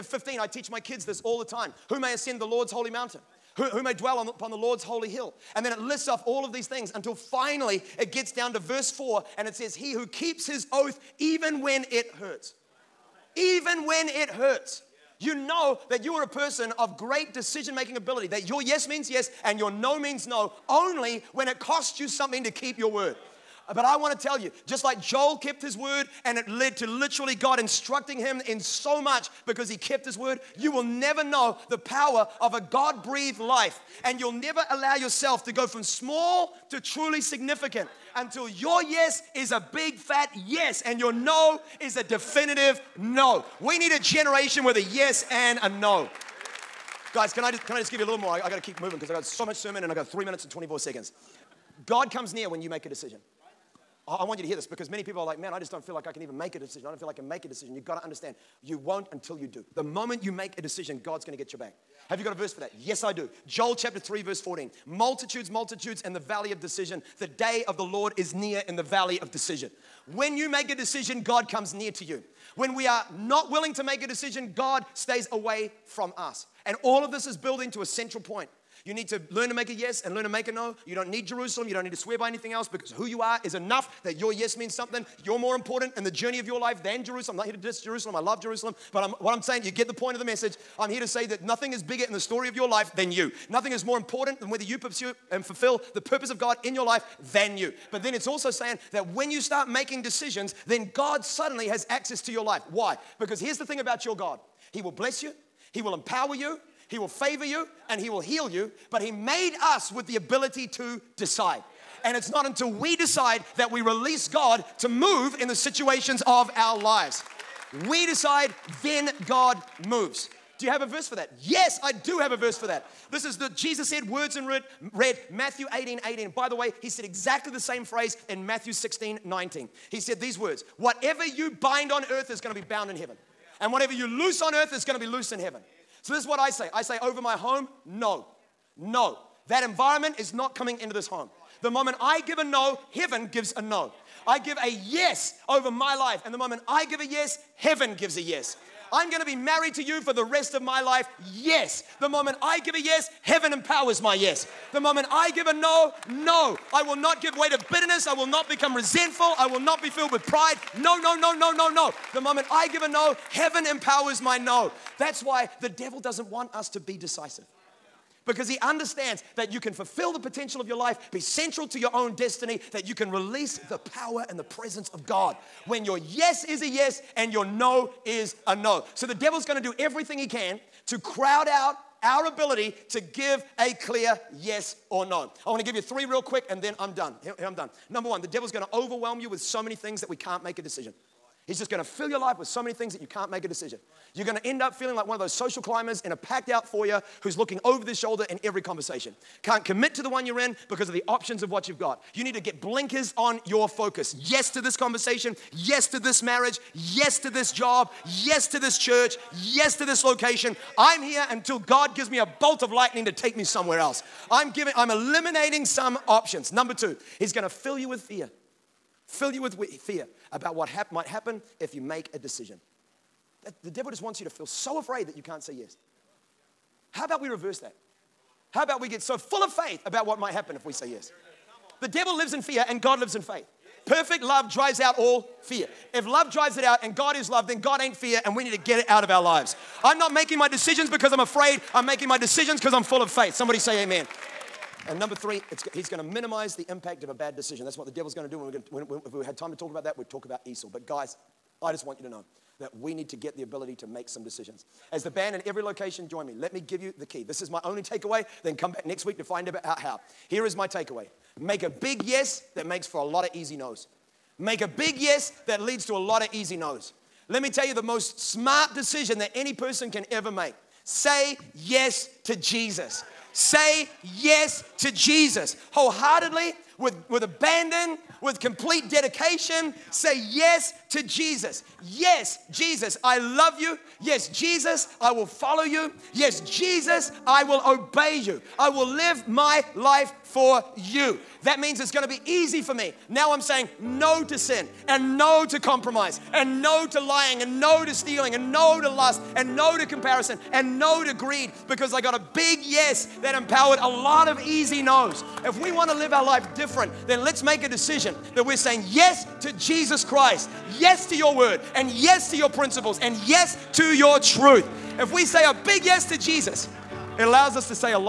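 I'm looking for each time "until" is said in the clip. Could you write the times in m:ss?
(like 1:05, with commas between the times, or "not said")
0:06, 0:38, 0:59, 1:52, 3:31.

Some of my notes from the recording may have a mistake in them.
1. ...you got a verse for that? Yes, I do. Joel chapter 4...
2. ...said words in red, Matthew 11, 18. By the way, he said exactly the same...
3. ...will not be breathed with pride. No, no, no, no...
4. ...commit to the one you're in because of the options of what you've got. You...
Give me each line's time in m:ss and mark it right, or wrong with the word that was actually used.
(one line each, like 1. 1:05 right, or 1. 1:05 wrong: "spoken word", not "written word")
1. 1:02 wrong: "3", not "4"
2. 2:03 wrong: "18", not "11"
3. 2:39 wrong: "filled", not "breathed"
4. 3:19 right.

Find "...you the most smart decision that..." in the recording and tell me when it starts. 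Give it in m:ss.
4:27.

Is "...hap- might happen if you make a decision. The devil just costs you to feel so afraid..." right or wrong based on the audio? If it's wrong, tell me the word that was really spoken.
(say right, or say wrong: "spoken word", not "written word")
wrong: "wants", not "costs".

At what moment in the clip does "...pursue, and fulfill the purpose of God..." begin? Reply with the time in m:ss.
1:34.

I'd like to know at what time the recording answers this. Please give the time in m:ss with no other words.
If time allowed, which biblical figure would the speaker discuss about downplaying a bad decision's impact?
4:10.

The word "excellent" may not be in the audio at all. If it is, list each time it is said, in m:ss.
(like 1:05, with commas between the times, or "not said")
not said.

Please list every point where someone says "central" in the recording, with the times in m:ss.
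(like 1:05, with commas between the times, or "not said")
1:17, 2:51.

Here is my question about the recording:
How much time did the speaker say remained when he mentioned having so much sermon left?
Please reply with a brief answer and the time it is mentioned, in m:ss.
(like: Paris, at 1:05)
3 minutes 24 seconds, at 0:50.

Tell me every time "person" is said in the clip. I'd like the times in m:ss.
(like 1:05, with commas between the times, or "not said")
0:16, 4:29.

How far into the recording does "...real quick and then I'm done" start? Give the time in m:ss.
3:06.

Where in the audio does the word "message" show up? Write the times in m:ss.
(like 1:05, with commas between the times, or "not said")
1:30.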